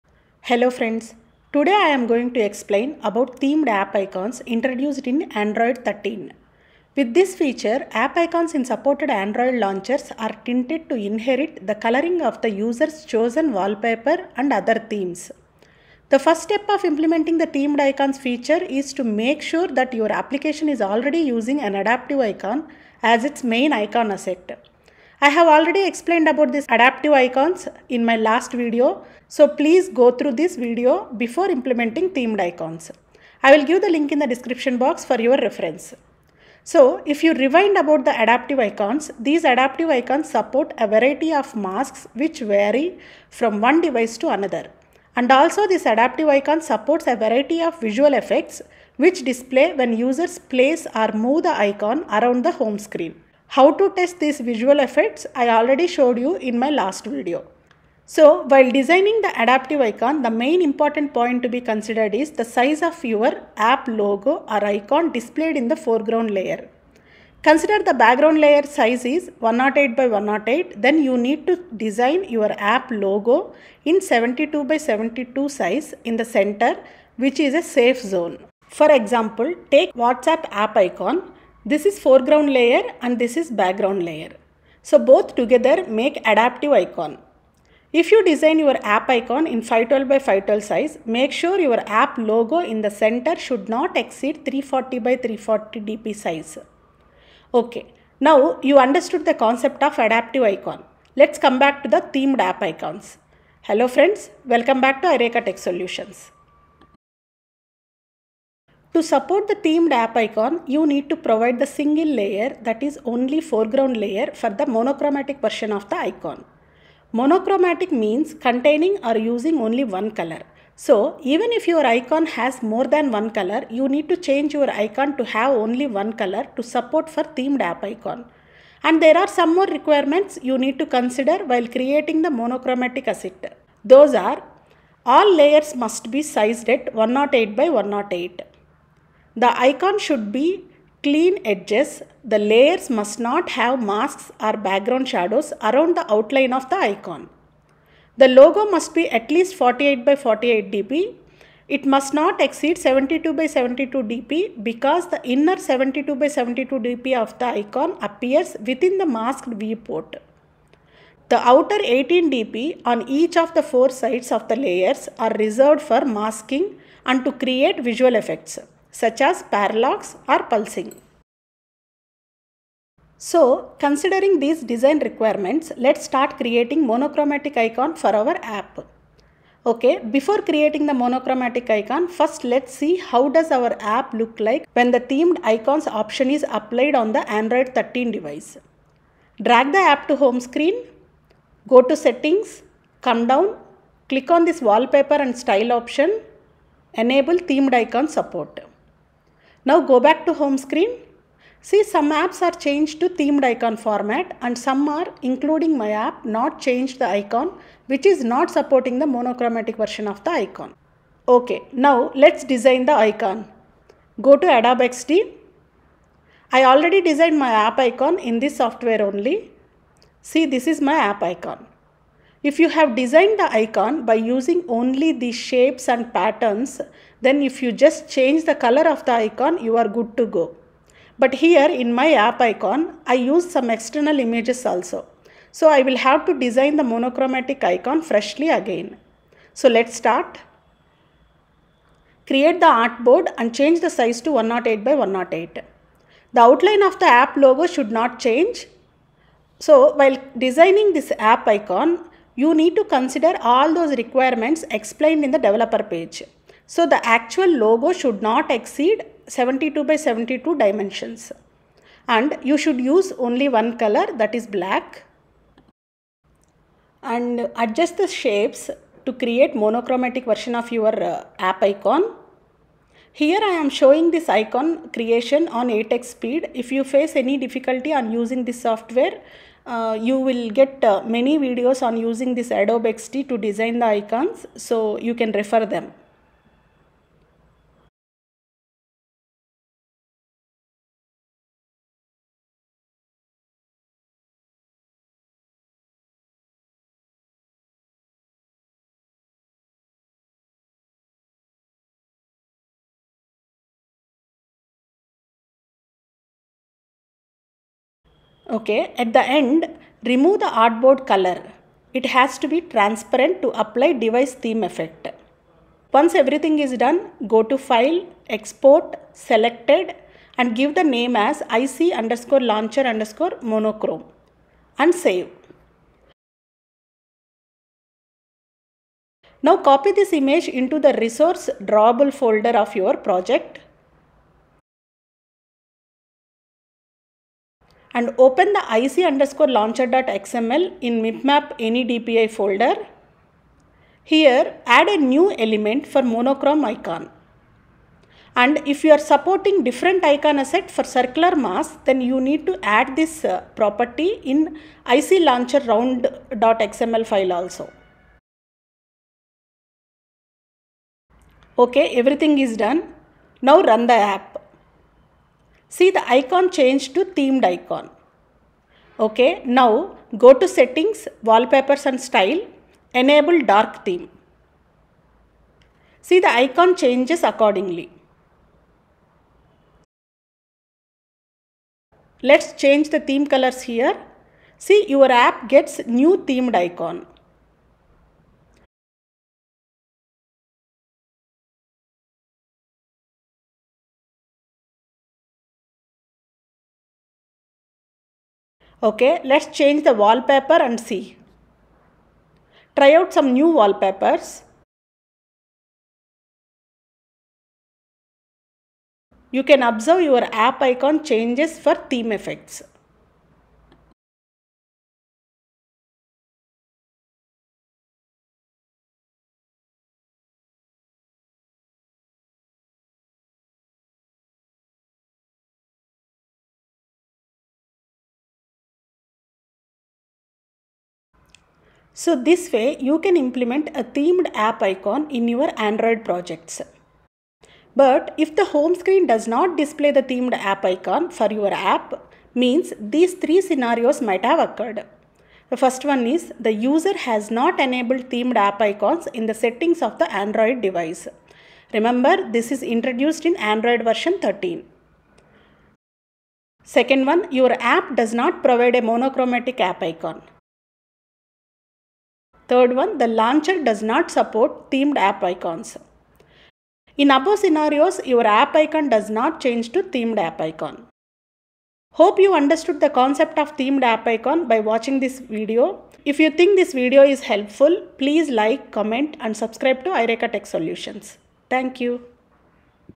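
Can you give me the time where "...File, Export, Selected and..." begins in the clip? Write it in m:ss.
5:17.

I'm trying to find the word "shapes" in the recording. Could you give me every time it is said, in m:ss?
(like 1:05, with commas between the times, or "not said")
3:45, 4:28.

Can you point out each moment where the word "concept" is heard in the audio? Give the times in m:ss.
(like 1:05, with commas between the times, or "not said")
1:39, 7:52.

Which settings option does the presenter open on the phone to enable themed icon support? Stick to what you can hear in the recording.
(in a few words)
wallpaper and style.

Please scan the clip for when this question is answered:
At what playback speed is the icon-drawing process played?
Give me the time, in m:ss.
4:35.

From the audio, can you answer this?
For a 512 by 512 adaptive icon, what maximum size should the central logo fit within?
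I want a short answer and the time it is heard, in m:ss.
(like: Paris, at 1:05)
340 by 340 dp, at 1:34.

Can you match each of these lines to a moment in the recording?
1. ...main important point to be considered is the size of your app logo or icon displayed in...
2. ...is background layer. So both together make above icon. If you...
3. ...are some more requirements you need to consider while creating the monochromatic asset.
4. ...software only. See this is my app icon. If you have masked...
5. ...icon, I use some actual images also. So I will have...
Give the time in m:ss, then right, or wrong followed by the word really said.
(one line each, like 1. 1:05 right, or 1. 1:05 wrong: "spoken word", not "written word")
1. 1:00 right
2. 1:23 wrong: "adaptive", not "above"
3. 2:09 right
4. 3:38 wrong: "designed", not "masked"
5. 3:52 wrong: "external", not "actual".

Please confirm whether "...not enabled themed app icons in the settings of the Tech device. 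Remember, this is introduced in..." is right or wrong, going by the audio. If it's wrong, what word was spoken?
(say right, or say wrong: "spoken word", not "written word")
wrong: "Android", not "Tech".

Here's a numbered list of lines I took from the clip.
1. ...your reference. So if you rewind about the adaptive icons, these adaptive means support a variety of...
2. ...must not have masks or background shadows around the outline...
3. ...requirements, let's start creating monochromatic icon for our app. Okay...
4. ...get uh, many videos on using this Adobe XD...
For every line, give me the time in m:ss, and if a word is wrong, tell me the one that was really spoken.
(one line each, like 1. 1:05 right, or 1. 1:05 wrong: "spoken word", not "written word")
1. 0:35 wrong: "icons", not "means"
2. 2:22 right
3. 2:54 right
4. 4:40 right.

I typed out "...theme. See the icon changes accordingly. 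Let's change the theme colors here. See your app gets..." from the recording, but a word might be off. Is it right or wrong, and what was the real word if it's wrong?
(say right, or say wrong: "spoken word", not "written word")
right.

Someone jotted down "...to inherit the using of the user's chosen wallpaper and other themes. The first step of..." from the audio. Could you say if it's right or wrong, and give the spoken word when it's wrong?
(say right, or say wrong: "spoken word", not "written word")
wrong: "coloring", not "using".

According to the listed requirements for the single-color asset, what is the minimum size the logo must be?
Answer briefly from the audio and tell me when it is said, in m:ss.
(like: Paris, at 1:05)
48 by 48 dp, at 2:29.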